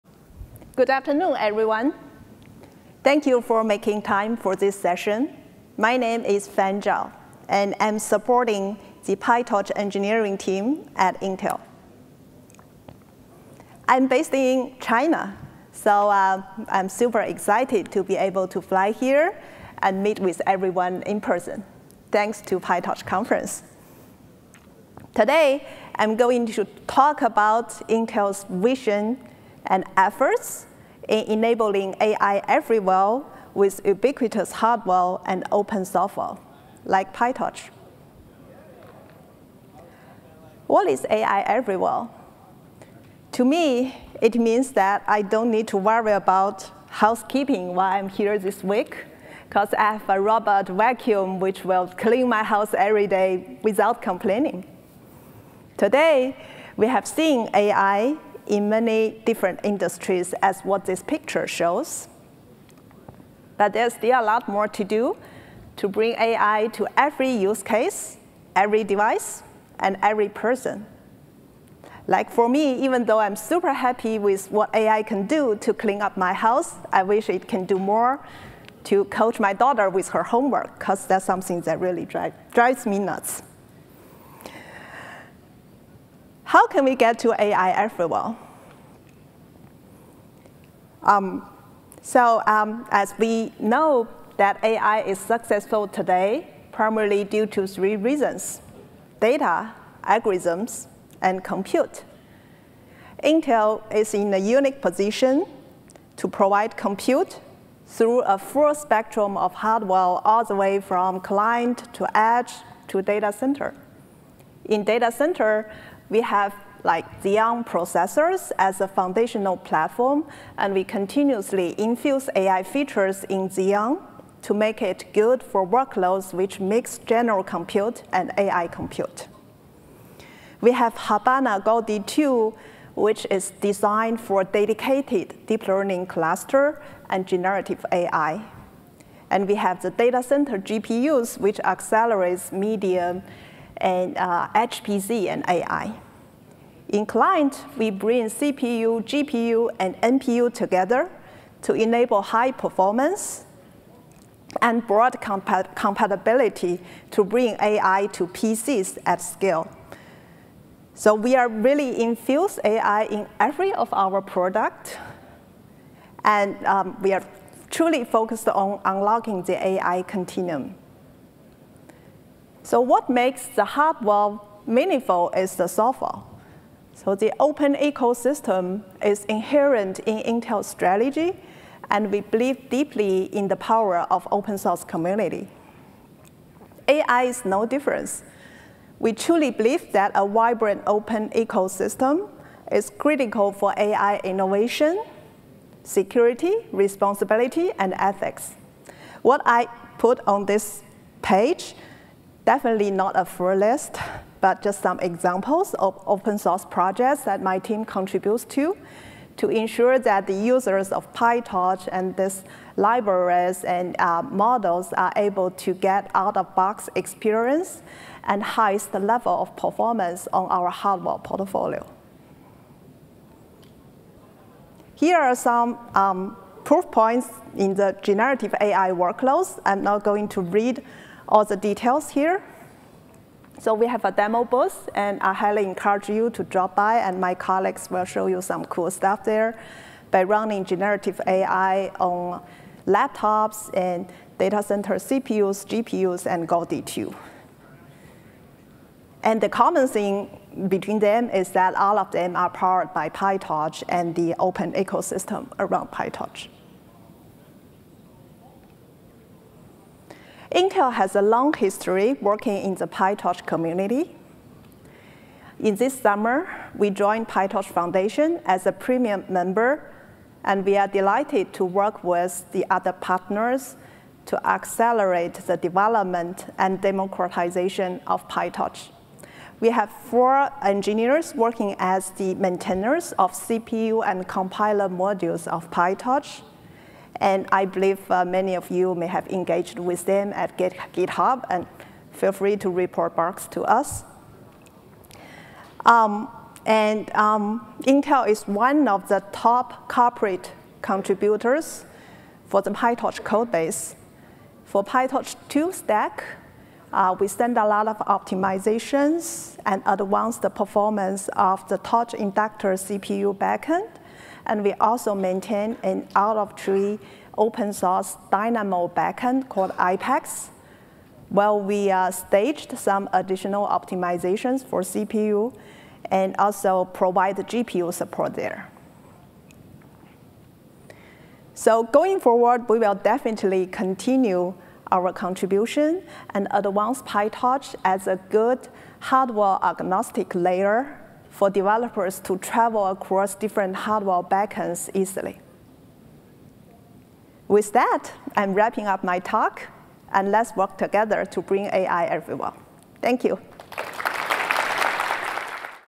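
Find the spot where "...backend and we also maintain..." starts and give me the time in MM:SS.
05:13.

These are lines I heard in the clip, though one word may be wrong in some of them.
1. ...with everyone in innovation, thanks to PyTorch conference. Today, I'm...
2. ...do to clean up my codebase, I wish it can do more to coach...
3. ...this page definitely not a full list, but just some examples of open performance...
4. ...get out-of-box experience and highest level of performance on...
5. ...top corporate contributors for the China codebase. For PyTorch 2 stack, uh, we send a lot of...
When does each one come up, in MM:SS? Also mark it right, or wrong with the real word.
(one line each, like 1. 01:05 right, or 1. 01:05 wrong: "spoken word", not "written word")
1. 00:20 wrong: "person", not "innovation"
2. 01:15 wrong: "house", not "codebase"
3. 03:20 wrong: "source", not "performance"
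4. 03:35 right
5. 04:59 wrong: "PyTorch", not "China".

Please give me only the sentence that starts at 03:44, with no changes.
Here are some um, proof points in the generative AI workloads.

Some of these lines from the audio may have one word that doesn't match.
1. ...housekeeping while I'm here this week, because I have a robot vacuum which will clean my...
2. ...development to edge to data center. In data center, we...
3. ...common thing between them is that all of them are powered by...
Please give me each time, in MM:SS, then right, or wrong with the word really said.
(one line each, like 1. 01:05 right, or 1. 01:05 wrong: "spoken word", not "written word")
1. 00:46 right
2. 01:51 wrong: "client", not "development"
3. 04:09 right.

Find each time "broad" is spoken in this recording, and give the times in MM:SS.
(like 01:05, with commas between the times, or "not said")
02:34.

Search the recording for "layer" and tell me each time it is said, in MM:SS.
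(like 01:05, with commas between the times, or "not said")
05:40.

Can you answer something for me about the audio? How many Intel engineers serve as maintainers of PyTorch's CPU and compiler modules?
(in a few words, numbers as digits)
4.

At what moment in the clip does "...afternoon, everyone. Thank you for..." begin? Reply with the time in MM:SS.
00:00.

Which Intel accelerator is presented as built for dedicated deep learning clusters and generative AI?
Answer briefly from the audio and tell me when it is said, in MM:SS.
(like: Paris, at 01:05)
Habana Gaudi 2, at 02:10.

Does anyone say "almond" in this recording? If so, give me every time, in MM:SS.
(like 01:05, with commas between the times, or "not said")
not said.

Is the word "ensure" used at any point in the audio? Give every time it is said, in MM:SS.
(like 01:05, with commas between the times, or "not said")
03:29.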